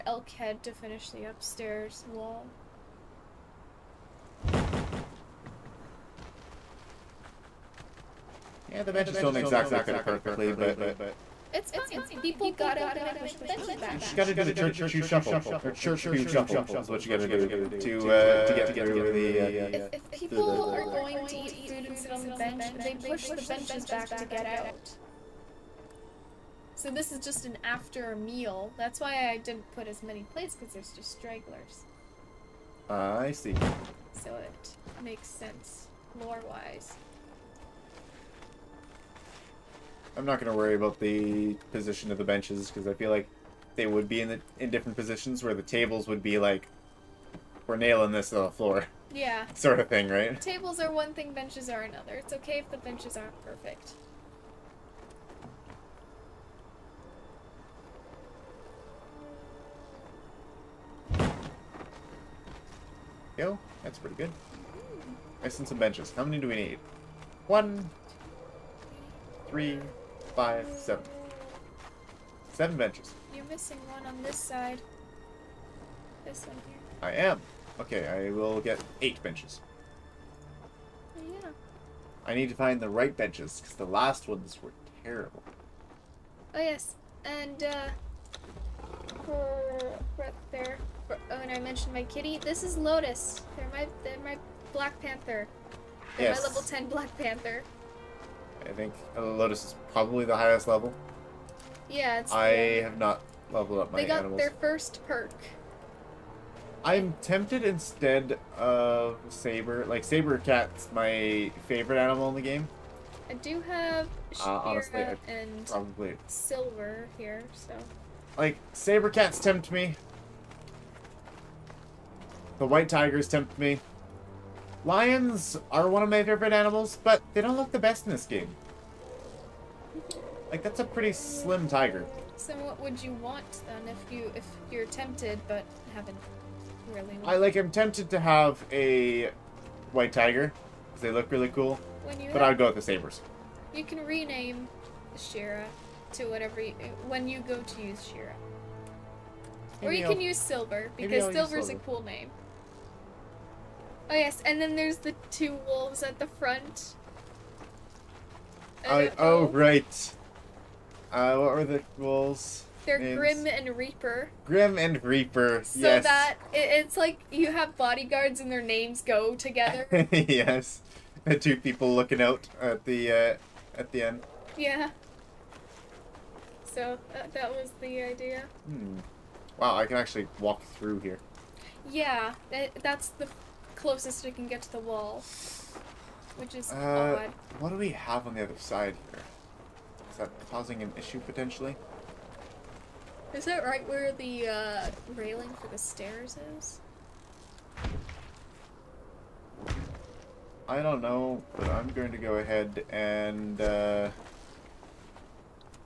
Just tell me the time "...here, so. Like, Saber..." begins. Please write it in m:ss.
1:57.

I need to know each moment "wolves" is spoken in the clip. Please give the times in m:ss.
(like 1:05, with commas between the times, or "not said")
2:35, 2:41.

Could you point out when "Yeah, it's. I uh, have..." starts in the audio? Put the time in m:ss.
1:41.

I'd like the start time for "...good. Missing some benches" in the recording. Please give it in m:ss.
1:04.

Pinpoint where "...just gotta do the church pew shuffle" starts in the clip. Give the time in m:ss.
0:13.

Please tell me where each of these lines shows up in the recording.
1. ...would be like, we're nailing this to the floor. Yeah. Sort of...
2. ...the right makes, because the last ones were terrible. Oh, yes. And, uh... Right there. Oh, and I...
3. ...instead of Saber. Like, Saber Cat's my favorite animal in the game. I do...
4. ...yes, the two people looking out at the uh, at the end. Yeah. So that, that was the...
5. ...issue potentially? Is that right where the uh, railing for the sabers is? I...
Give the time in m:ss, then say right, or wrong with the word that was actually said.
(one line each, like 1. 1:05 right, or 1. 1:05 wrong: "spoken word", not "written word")
1. 0:46 right
2. 1:22 wrong: "benches", not "makes"
3. 1:47 right
4. 2:50 right
5. 3:10 wrong: "stairs", not "sabers".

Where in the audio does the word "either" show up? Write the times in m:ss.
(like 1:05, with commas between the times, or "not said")
not said.